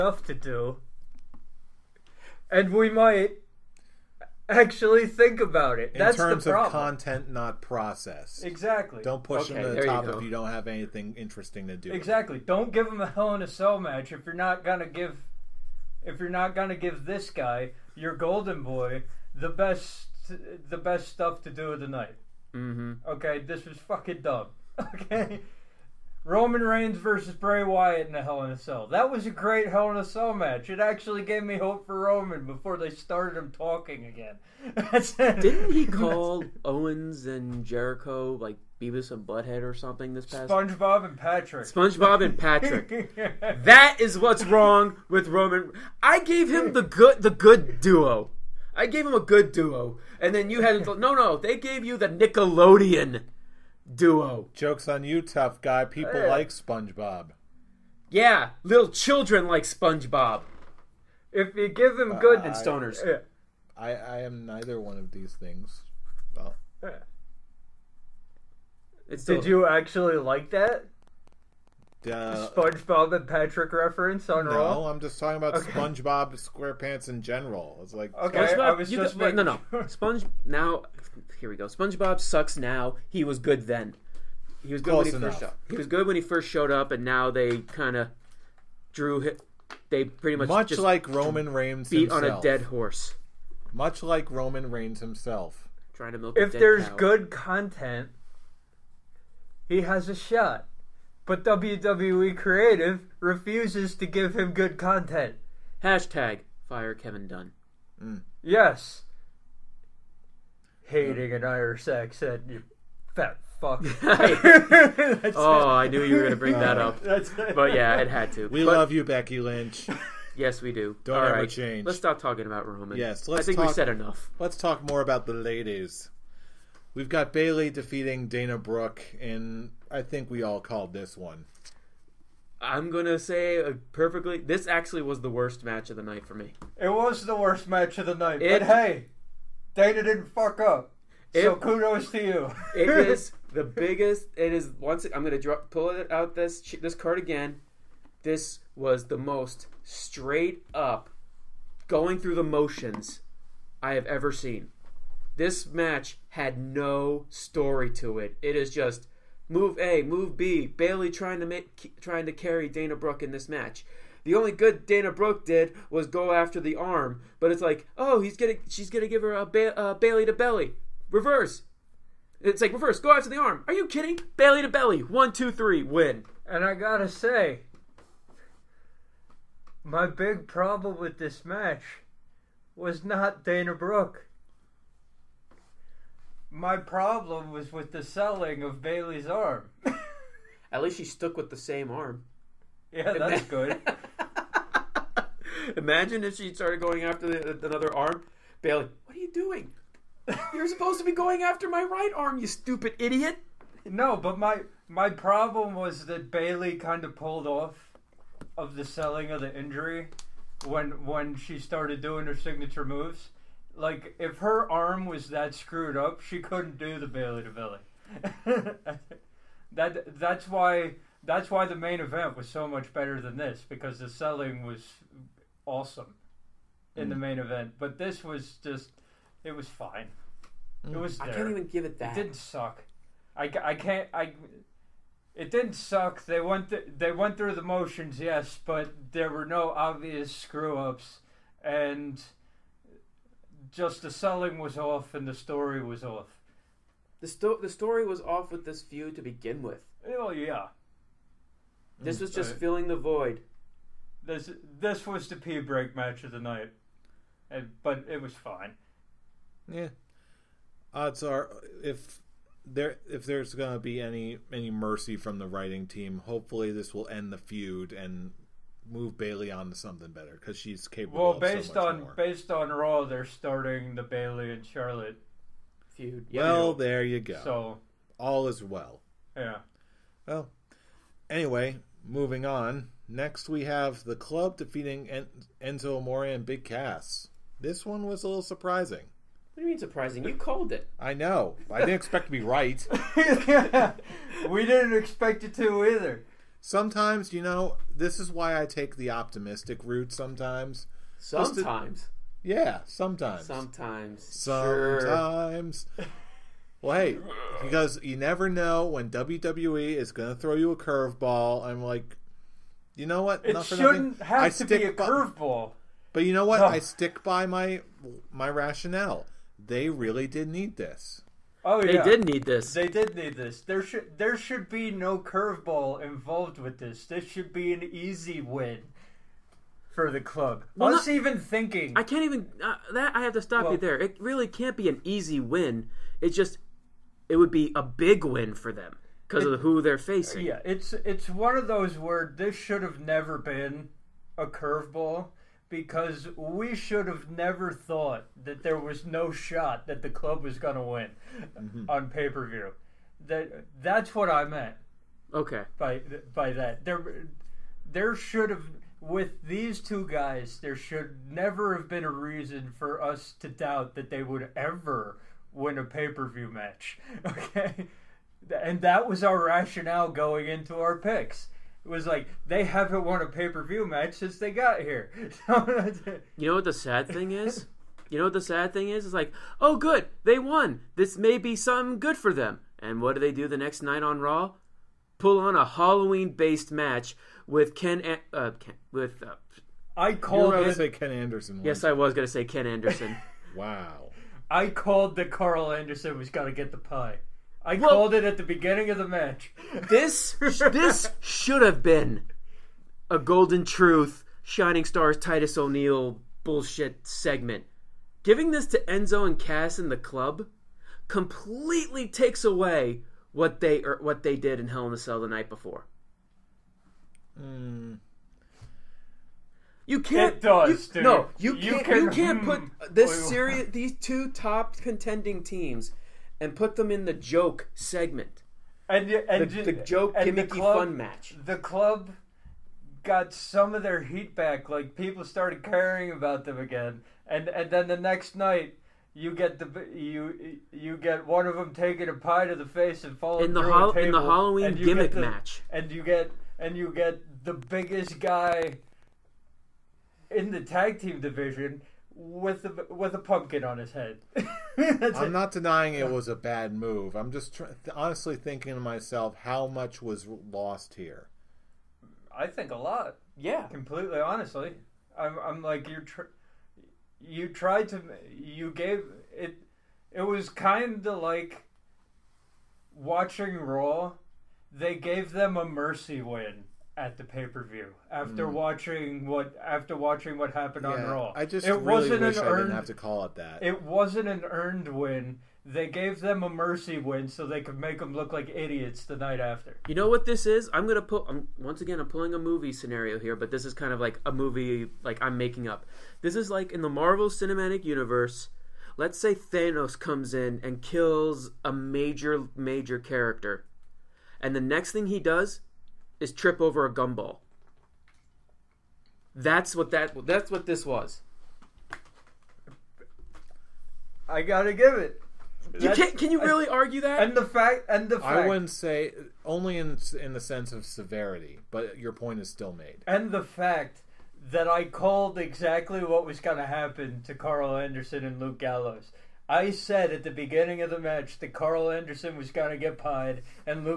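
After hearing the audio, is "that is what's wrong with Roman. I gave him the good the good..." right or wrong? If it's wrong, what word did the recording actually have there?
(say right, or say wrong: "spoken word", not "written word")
right.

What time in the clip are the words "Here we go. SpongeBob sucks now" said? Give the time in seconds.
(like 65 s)
81 s.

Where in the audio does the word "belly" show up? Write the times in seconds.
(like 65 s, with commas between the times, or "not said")
170 s, 174 s, 217 s.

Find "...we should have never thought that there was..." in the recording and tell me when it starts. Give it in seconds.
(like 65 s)
346 s.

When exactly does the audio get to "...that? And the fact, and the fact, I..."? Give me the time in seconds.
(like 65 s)
517 s.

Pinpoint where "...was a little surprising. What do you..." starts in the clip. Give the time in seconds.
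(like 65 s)
288 s.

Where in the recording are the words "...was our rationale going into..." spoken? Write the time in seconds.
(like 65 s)
369 s.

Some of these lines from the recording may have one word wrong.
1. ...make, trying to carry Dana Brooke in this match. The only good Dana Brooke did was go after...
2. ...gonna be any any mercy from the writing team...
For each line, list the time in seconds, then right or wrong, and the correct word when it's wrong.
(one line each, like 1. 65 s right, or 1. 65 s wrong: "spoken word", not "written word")
1. 161 s right
2. 263 s right.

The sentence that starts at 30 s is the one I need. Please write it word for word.
It actually gave me hope for Roman before they started him talking again.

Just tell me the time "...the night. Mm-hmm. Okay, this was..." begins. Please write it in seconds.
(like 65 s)
21 s.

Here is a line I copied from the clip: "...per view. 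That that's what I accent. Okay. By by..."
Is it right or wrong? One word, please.
wrong.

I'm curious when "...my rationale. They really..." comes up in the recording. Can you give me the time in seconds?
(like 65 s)
318 s.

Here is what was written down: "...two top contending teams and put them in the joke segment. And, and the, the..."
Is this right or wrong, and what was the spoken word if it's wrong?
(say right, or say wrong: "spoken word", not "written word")
right.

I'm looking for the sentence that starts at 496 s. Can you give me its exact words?
This is like in the Marvel Cinematic Universe.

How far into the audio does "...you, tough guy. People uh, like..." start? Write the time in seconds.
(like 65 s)
55 s.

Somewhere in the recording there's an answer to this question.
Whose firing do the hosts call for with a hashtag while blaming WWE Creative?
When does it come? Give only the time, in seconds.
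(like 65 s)
106 s.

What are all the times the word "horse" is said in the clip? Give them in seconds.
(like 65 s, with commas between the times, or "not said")
92 s.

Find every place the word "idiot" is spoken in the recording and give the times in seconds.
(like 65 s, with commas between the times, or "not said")
202 s, 488 s.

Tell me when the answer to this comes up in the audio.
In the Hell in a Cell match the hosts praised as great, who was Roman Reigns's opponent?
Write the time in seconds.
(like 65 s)
27 s.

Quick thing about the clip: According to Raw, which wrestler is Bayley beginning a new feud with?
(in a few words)
Charlotte.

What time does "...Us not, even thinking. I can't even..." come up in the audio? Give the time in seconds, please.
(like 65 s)
330 s.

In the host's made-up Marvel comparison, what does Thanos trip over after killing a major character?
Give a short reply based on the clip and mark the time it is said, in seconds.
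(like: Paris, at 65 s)
a gumball, at 506 s.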